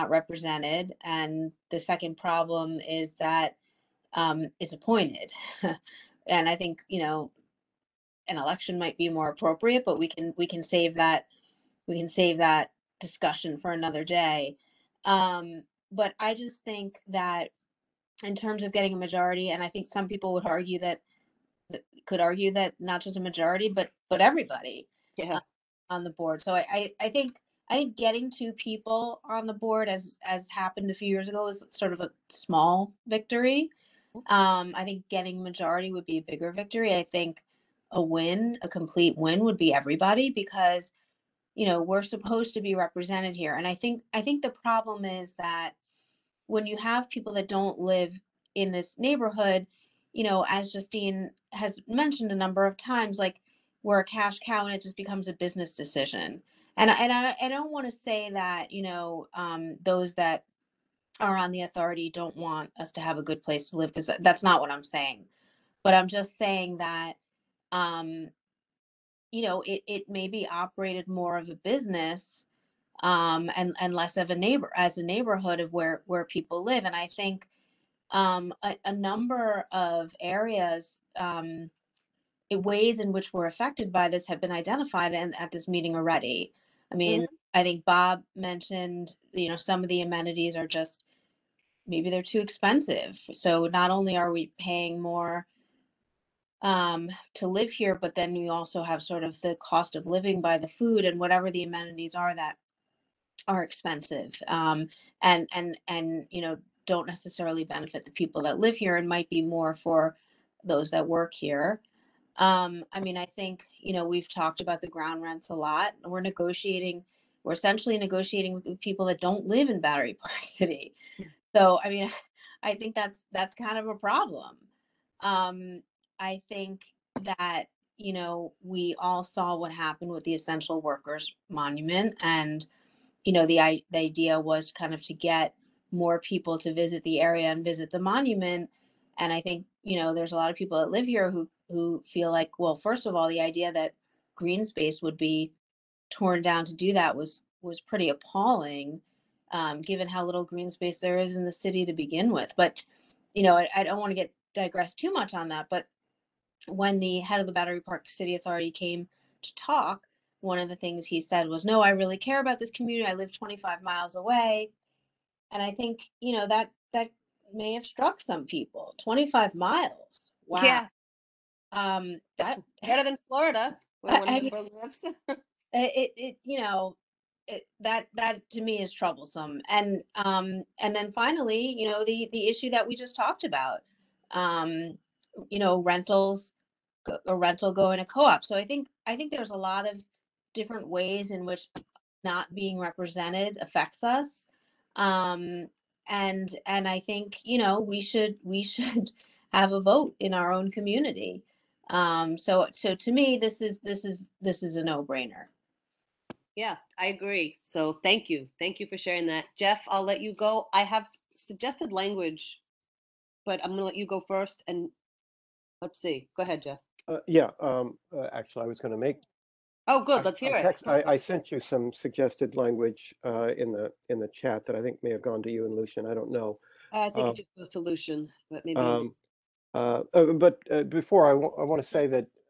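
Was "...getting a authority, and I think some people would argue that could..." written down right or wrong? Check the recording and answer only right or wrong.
wrong.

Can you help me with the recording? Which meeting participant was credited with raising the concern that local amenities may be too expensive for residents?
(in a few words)
Bob.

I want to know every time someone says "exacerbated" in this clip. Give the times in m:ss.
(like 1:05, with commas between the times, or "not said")
not said.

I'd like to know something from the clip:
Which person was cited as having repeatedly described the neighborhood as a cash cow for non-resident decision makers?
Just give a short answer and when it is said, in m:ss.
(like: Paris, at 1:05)
Justine, at 0:50.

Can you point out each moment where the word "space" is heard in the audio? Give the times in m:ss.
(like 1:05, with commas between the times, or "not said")
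2:24, 2:30.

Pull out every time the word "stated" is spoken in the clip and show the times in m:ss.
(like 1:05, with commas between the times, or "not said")
not said.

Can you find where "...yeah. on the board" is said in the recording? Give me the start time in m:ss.
0:25.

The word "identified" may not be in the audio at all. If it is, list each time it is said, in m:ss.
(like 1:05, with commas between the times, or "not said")
1:24.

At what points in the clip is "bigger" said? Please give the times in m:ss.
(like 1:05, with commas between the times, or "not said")
0:36.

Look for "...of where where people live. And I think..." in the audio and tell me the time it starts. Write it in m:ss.
1:15.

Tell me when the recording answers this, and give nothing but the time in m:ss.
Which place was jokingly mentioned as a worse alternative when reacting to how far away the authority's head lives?
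2:53.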